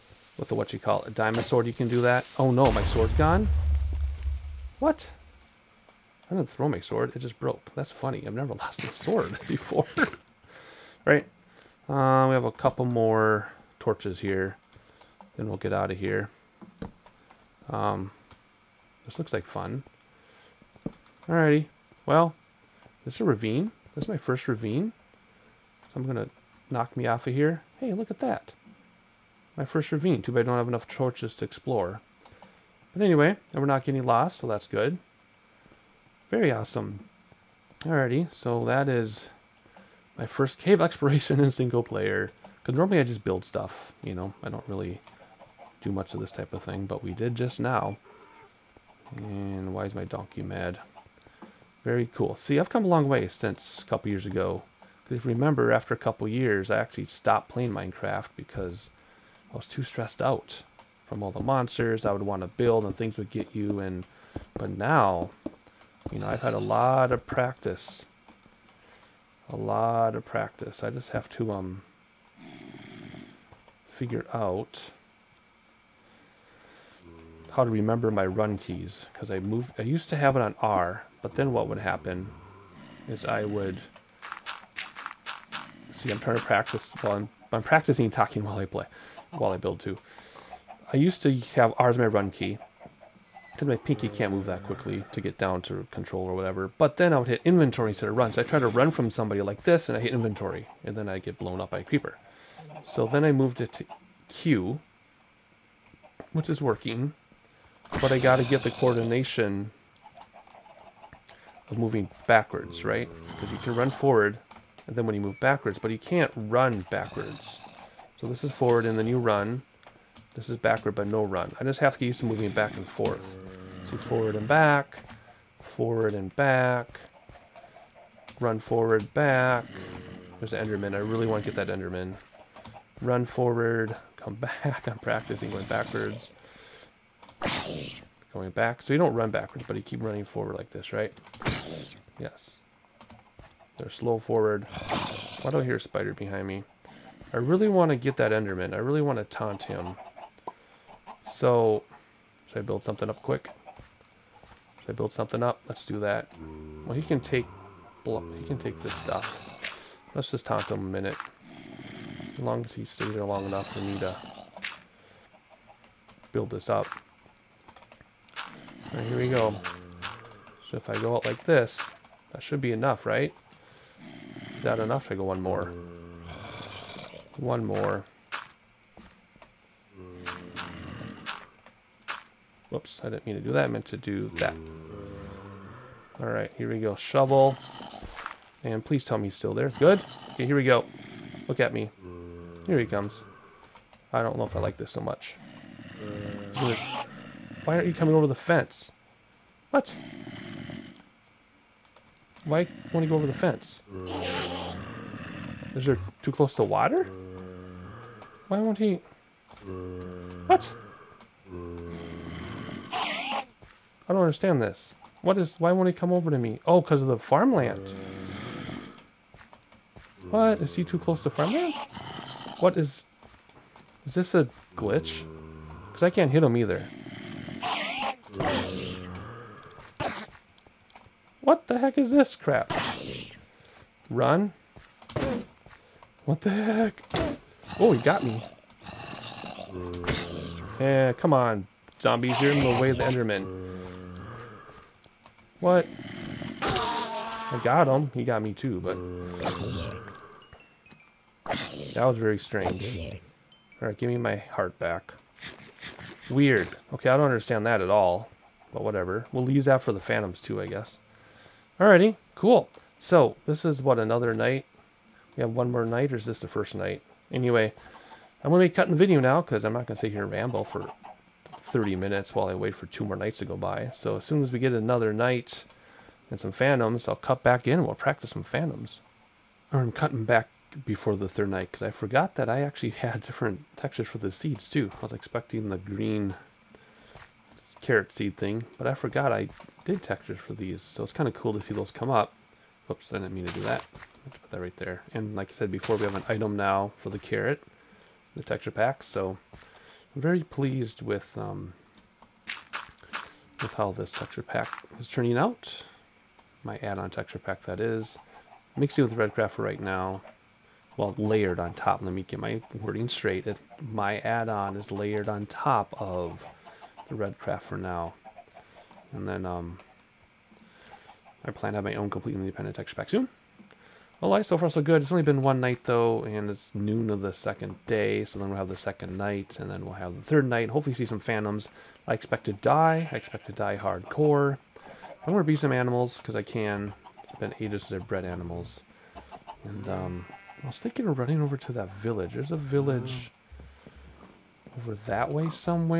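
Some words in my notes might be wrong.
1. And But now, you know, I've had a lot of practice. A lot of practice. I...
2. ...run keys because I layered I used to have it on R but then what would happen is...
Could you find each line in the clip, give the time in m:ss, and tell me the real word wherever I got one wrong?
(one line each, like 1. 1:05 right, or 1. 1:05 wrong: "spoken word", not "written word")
1. 1:03 right
2. 1:18 wrong: "moved", not "layered".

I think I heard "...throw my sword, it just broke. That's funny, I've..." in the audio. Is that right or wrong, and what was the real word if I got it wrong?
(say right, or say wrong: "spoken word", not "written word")
right.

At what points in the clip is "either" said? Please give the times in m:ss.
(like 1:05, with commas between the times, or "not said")
3:46.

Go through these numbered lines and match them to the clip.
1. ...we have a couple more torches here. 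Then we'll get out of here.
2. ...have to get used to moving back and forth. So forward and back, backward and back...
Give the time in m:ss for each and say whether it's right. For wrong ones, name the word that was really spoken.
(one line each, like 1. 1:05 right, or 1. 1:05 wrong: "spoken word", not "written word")
1. 0:12 right
2. 2:01 wrong: "forward", not "backward".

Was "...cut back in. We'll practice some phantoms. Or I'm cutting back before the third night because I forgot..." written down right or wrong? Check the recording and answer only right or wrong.
right.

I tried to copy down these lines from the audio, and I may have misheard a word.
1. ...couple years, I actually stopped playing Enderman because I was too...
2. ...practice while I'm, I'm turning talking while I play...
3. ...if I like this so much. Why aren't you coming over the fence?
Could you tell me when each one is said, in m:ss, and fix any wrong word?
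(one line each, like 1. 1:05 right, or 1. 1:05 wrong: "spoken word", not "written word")
1. 0:55 wrong: "Minecraft", not "Enderman"
2. 1:26 wrong: "practicing", not "turning"
3. 3:14 right.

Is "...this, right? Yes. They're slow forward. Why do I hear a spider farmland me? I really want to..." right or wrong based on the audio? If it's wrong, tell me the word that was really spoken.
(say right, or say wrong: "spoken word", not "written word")
wrong: "behind", not "farmland".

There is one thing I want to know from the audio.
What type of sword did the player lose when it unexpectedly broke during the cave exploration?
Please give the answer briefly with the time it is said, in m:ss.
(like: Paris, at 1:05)
Diamond sword, at 0:01.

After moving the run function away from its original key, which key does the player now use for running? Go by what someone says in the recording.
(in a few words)
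Q.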